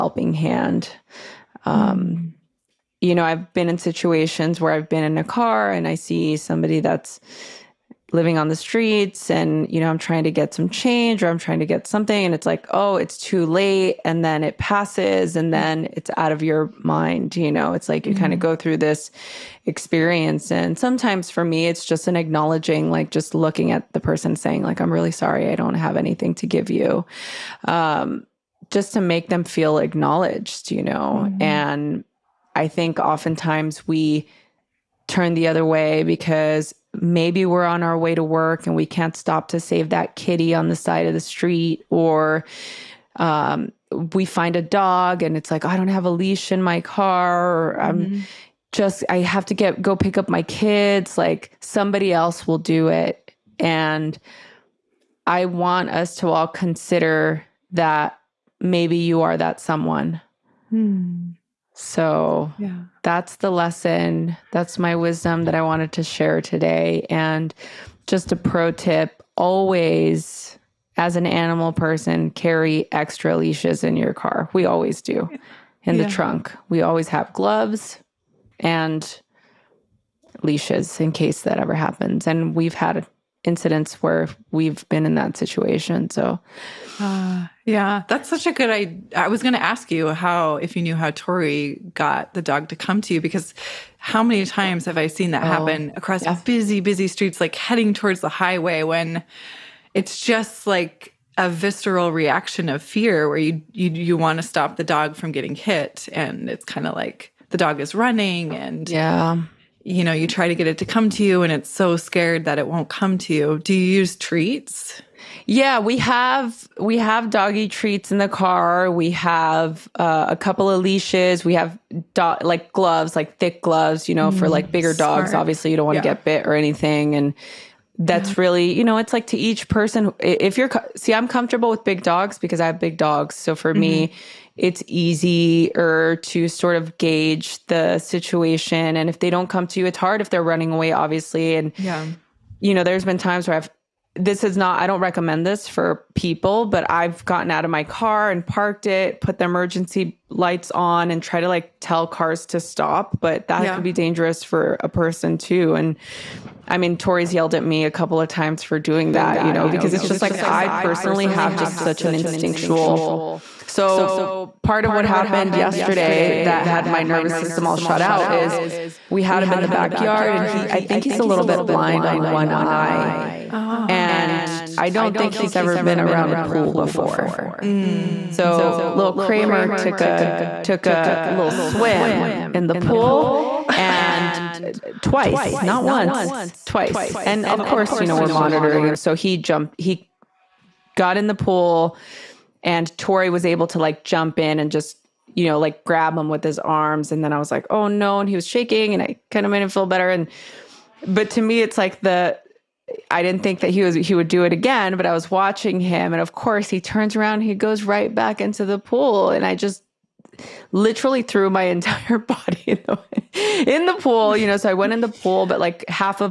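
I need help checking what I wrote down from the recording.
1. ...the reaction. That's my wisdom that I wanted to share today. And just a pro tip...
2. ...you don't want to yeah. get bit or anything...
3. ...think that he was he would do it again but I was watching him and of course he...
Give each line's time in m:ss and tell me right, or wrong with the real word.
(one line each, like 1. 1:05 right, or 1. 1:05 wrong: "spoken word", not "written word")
1. 1:03 wrong: "lesson", not "reaction"
2. 2:05 right
3. 3:23 right.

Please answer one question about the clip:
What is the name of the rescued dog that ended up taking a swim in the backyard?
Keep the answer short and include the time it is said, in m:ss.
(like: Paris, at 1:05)
Kramer, at 2:59.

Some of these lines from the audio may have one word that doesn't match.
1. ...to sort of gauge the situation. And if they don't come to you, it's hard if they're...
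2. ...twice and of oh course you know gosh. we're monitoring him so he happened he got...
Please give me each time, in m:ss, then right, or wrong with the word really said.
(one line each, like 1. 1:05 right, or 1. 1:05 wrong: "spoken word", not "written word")
1. 2:16 right
2. 3:06 wrong: "jumped", not "happened".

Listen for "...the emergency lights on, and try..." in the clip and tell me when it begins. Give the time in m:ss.
2:29.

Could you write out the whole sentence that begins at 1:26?
So, uh, yeah, that's such a good idea.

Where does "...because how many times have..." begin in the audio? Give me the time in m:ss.
1:33.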